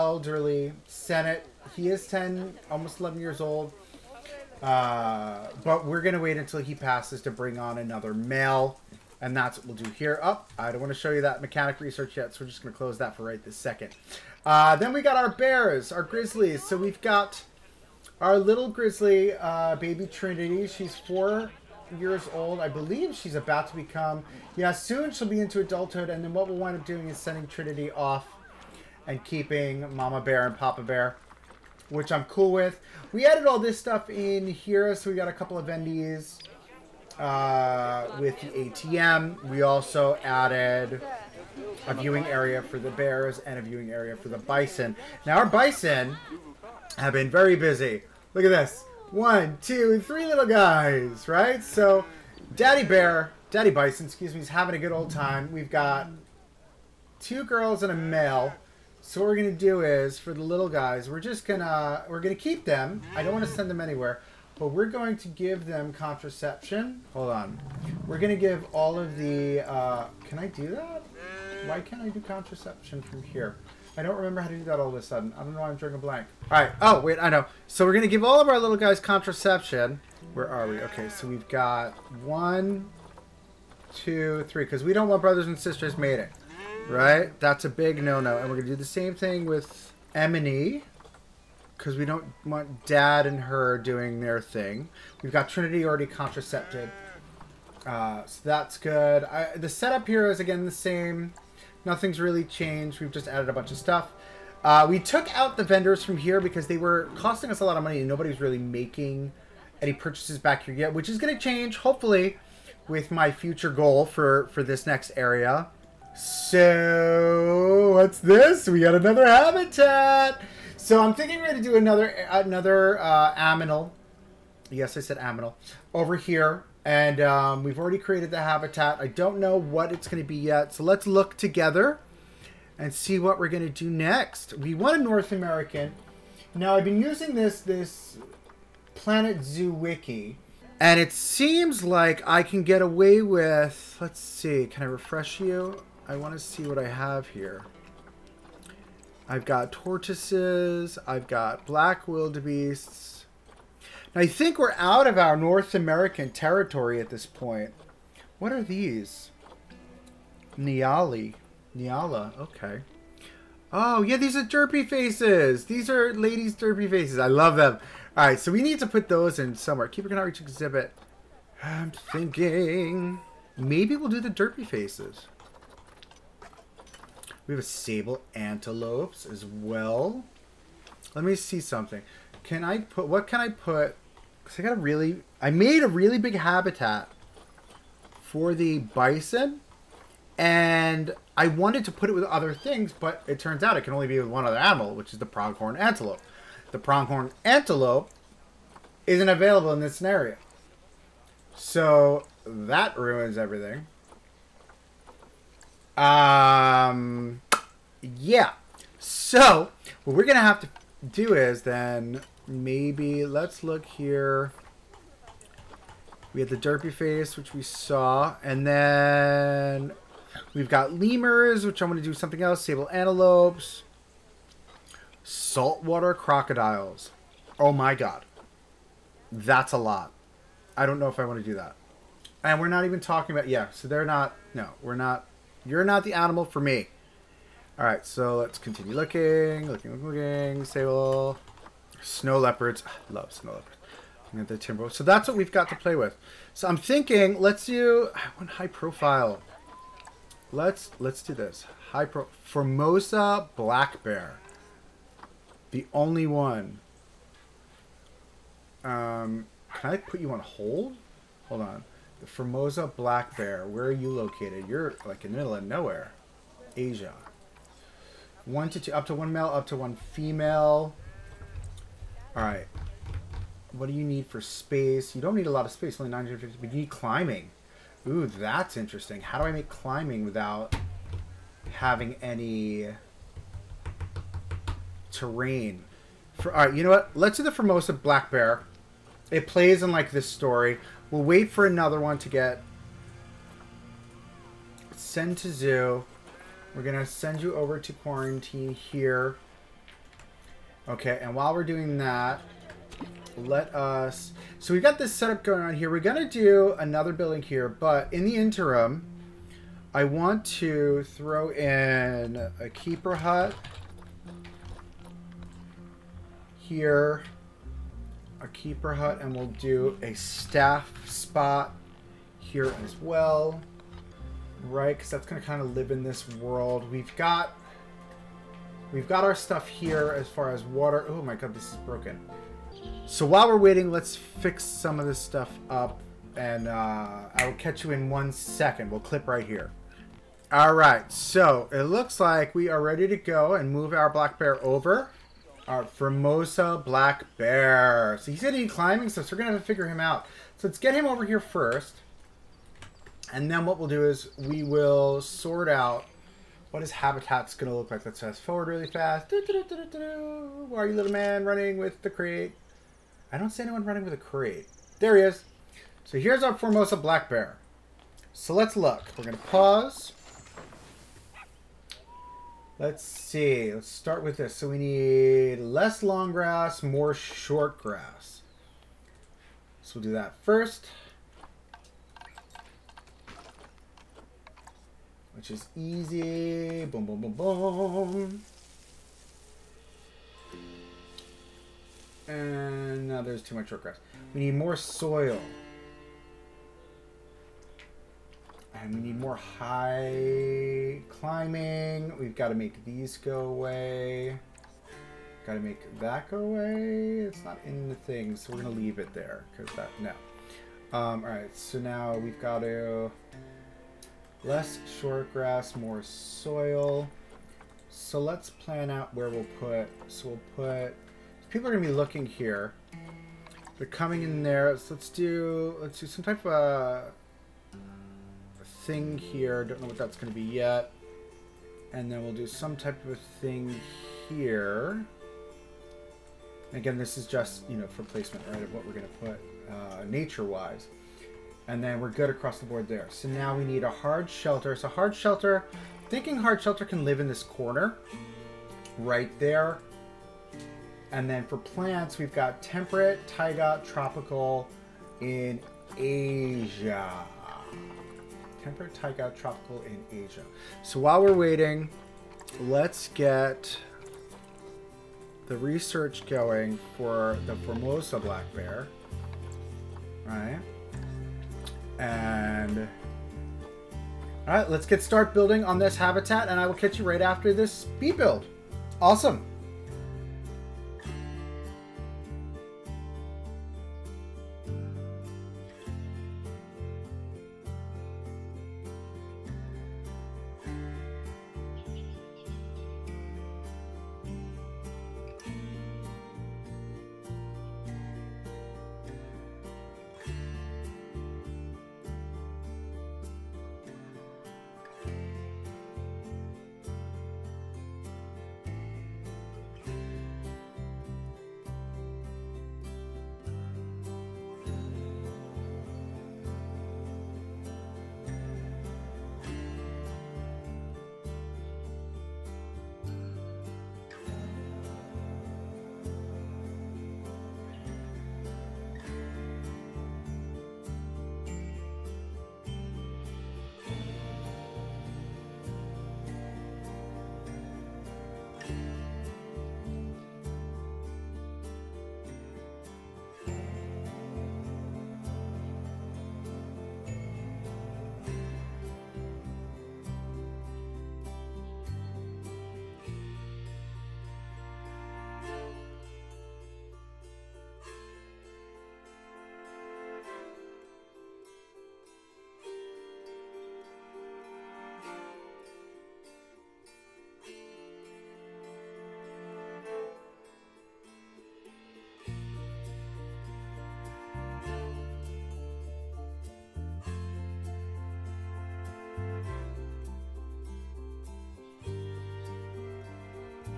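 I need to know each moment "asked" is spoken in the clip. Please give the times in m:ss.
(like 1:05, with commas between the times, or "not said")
not said.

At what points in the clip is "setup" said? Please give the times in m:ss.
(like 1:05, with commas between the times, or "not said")
1:39, 5:05.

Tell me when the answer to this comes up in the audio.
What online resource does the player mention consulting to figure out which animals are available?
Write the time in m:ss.
2:18.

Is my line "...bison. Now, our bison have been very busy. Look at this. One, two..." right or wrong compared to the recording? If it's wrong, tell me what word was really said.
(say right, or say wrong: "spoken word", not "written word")
right.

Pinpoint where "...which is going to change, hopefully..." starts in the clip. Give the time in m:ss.
1:50.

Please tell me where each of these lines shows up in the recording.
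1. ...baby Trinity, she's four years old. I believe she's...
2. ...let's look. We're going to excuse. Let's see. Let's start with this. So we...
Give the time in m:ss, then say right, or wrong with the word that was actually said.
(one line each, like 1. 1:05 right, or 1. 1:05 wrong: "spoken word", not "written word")
1. 0:19 right
2. 6:08 wrong: "pause", not "excuse".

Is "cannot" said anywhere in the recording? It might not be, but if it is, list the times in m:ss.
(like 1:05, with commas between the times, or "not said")
2:50.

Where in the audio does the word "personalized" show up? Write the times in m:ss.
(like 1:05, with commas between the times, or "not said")
not said.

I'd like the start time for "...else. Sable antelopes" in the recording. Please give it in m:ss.
3:42.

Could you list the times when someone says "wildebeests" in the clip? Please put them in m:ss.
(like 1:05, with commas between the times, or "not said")
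2:32.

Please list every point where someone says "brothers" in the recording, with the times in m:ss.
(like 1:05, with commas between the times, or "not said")
1:25.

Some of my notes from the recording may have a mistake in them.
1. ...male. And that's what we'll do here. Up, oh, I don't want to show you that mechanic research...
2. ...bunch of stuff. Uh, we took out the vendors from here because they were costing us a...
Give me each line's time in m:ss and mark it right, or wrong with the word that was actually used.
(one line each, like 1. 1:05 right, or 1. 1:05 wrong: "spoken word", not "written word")
1. 0:08 right
2. 1:43 right.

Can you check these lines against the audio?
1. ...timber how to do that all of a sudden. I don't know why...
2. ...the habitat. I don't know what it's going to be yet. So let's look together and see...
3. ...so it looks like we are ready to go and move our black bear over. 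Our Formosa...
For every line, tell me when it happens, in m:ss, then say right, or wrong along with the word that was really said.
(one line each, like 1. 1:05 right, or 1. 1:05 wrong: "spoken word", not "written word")
1. 1:14 wrong: "remember", not "timber"
2. 2:08 right
3. 5:41 right.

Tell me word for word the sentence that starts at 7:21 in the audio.
And then we're good across the board there.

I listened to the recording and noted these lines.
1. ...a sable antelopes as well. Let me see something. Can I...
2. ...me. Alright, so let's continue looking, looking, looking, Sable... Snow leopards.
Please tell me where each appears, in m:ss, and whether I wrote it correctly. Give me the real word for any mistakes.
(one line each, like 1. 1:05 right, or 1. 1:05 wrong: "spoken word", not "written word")
1. 2:57 right
2. 3:56 right.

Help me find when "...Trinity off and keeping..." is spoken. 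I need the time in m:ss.
0:27.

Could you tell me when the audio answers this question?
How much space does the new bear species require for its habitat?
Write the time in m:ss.
4:36.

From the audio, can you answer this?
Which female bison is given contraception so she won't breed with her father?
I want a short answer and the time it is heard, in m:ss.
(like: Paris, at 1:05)
Emily, at 1:30.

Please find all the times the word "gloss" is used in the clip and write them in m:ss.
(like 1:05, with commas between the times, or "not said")
not said.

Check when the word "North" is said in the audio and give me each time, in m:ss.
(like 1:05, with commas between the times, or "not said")
2:15, 2:35.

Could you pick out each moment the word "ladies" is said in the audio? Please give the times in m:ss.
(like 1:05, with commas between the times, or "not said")
2:46.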